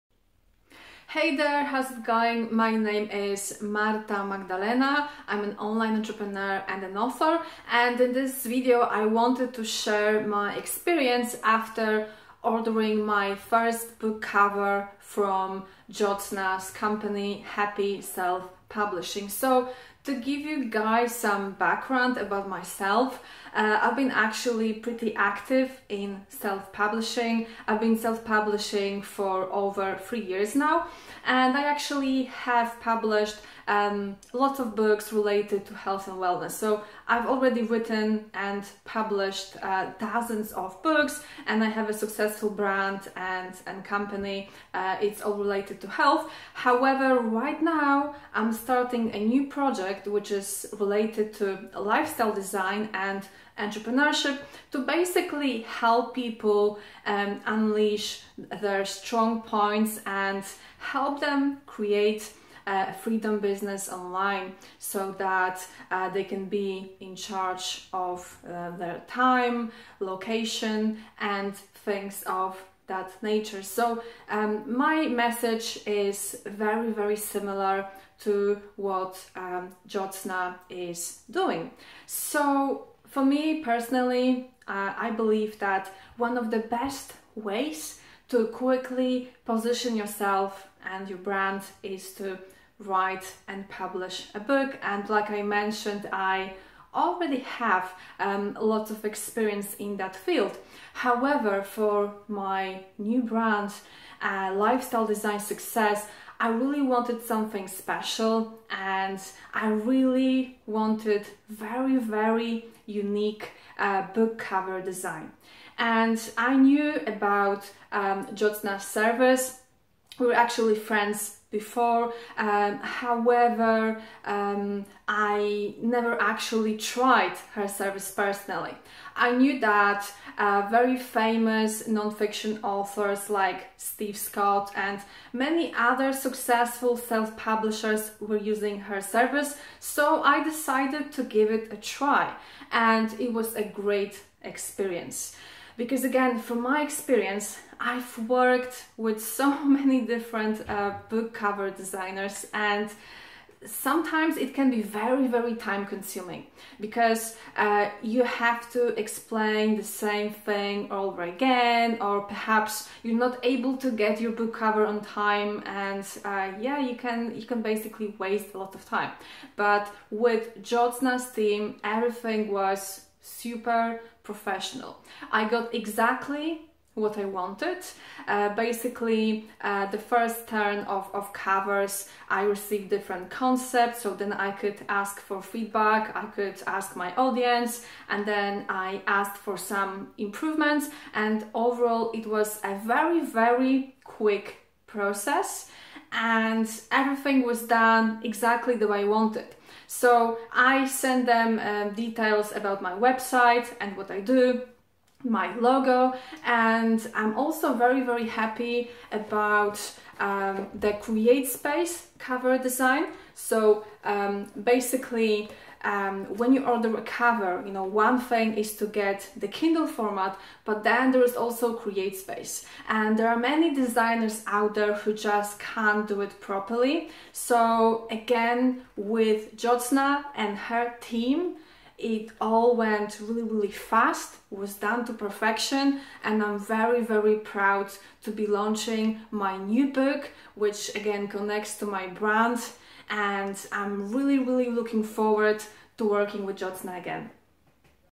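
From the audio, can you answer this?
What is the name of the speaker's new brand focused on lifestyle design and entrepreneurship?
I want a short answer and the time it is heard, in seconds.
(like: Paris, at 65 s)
Lifestyle Design Success, at 104 s.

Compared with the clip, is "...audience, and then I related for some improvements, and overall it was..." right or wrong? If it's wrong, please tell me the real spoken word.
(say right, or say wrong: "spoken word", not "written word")
wrong: "asked", not "related".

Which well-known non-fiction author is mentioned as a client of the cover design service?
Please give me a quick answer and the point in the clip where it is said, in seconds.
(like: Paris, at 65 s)
Steve Scott, at 133 s.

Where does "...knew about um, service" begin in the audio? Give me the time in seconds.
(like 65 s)
116 s.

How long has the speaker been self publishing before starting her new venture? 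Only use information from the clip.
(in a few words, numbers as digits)
Over 3 years.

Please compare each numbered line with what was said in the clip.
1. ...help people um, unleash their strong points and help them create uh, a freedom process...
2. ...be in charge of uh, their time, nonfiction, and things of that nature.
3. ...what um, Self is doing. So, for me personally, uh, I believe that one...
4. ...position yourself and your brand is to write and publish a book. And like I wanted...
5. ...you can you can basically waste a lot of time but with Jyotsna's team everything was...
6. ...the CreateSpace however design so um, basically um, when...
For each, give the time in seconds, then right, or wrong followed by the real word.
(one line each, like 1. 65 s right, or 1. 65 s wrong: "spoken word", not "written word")
1. 55 s wrong: "business", not "process"
2. 66 s wrong: "location", not "nonfiction"
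3. 78 s wrong: "Jyotsna", not "Self"
4. 89 s wrong: "mentioned", not "wanted"
5. 166 s right
6. 210 s wrong: "cover", not "however".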